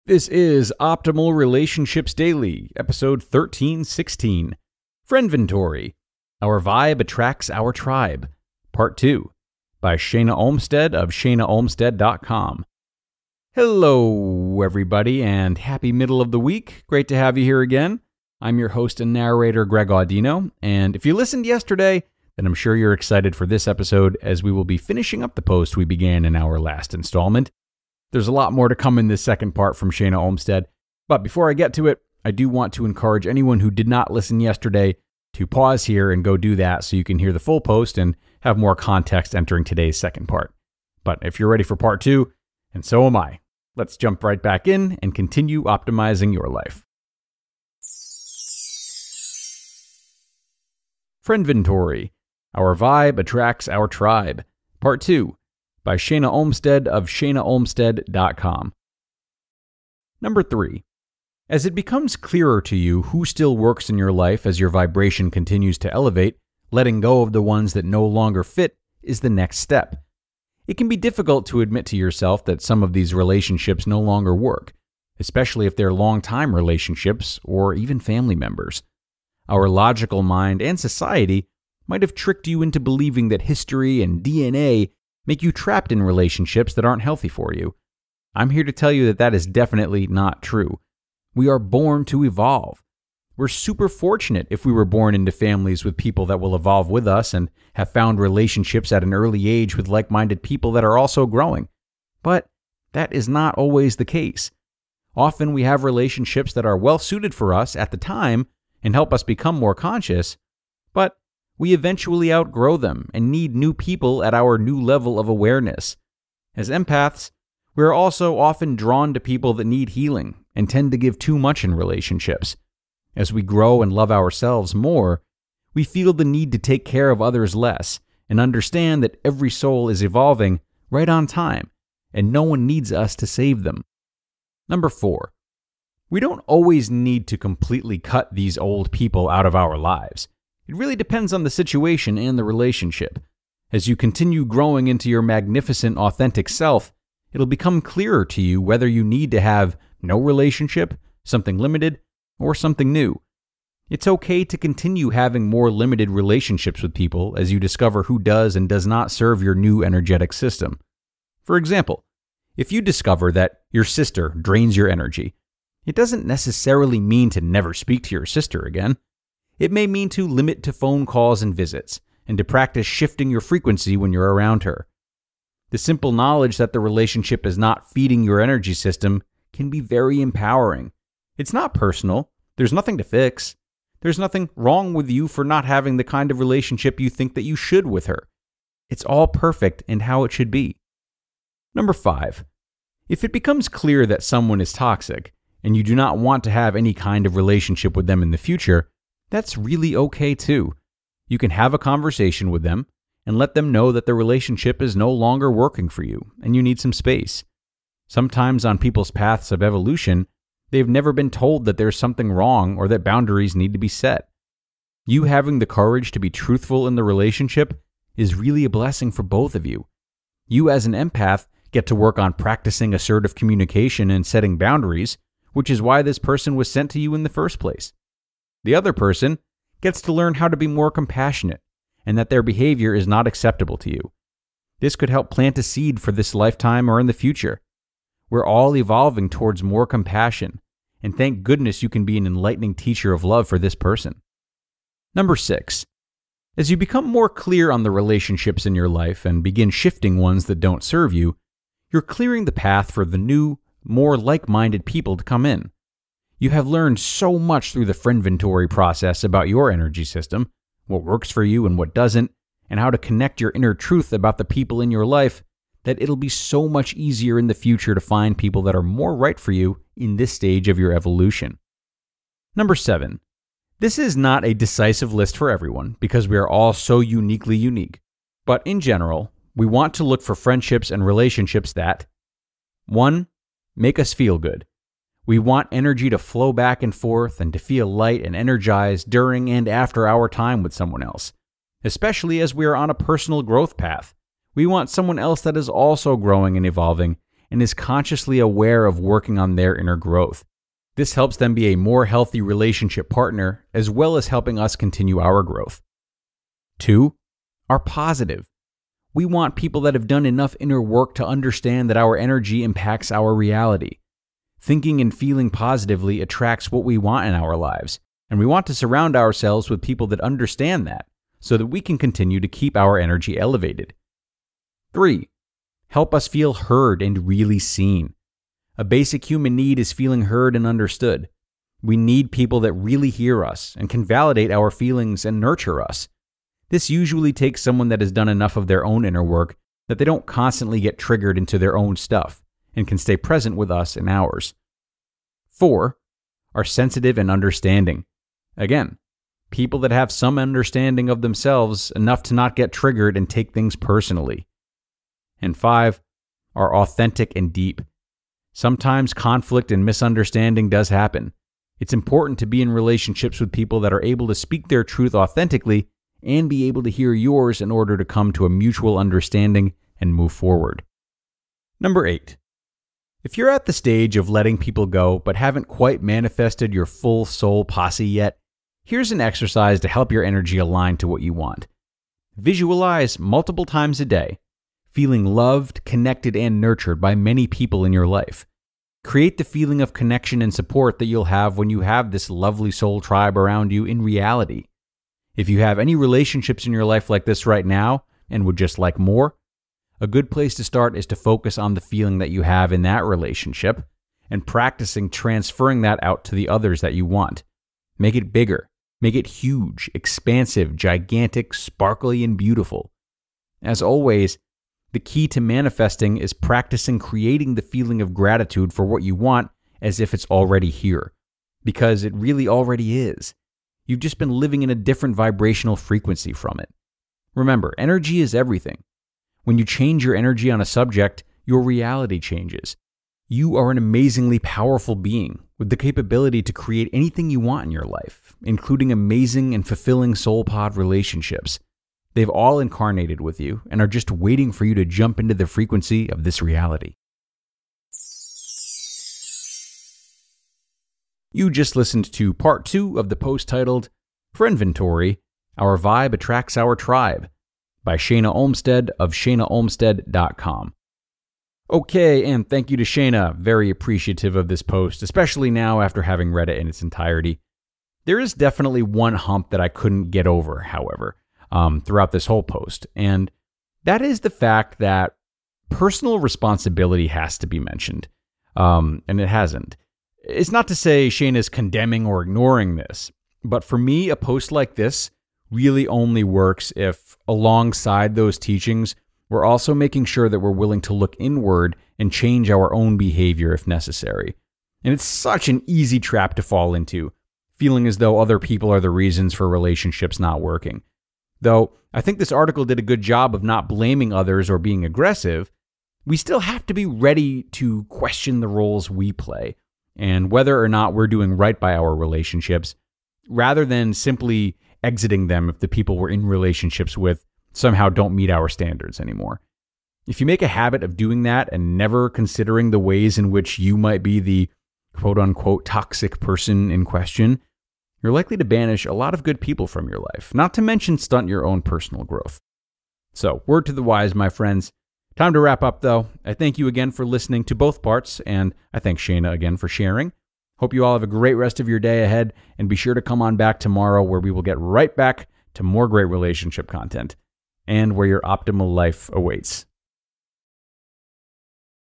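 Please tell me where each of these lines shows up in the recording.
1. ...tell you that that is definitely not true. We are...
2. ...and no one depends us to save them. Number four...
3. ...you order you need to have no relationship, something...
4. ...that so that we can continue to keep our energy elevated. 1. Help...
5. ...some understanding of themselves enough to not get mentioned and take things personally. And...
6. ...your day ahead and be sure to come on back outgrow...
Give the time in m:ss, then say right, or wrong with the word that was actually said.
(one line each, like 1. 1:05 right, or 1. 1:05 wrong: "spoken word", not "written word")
1. 1:28 right
2. 2:12 wrong: "needs", not "depends"
3. 2:28 wrong: "whether", not "order"
4. 5:20 wrong: "3", not "1"
5. 5:50 wrong: "triggered", not "mentioned"
6. 9:01 wrong: "tomorrow", not "outgrow".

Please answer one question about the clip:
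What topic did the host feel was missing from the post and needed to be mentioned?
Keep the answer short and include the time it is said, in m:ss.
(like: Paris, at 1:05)
Personal responsibility, at 7:55.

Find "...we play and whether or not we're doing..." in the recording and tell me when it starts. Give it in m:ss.
8:28.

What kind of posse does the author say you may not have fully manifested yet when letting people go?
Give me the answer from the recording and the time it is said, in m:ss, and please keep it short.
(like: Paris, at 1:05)
Soul posse, at 6:17.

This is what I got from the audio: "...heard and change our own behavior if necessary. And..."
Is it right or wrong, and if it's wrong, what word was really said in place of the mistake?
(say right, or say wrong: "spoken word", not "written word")
wrong: "inward", not "heard".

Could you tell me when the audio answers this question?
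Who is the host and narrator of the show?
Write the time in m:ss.
0:19.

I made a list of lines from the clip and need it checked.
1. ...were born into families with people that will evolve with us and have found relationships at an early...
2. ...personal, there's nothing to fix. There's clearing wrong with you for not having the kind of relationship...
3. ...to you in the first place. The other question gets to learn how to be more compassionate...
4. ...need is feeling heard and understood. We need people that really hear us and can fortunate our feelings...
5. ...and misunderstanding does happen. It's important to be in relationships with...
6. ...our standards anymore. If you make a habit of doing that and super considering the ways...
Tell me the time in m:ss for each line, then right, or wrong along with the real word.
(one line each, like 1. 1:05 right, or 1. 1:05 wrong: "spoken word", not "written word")
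1. 1:34 right
2. 3:01 wrong: "nothing", not "clearing"
3. 3:46 wrong: "person", not "question"
4. 5:29 wrong: "validate", not "fortunate"
5. 5:59 right
6. 8:38 wrong: "never", not "super".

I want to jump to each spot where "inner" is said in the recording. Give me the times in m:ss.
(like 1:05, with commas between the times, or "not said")
4:23, 4:59, 5:10, 5:39.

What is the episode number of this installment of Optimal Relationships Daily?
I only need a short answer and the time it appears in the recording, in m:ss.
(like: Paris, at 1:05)
1316, at 0:03.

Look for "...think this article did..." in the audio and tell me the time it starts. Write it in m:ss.
8:22.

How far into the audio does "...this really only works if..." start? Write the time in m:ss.
8:04.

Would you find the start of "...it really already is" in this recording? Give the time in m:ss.
7:02.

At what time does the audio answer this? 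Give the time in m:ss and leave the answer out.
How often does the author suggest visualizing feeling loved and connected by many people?
6:23.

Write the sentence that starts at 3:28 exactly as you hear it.
Sometimes on people's paths of evolution, they've never been told that there's something wrong or that boundaries need to be set.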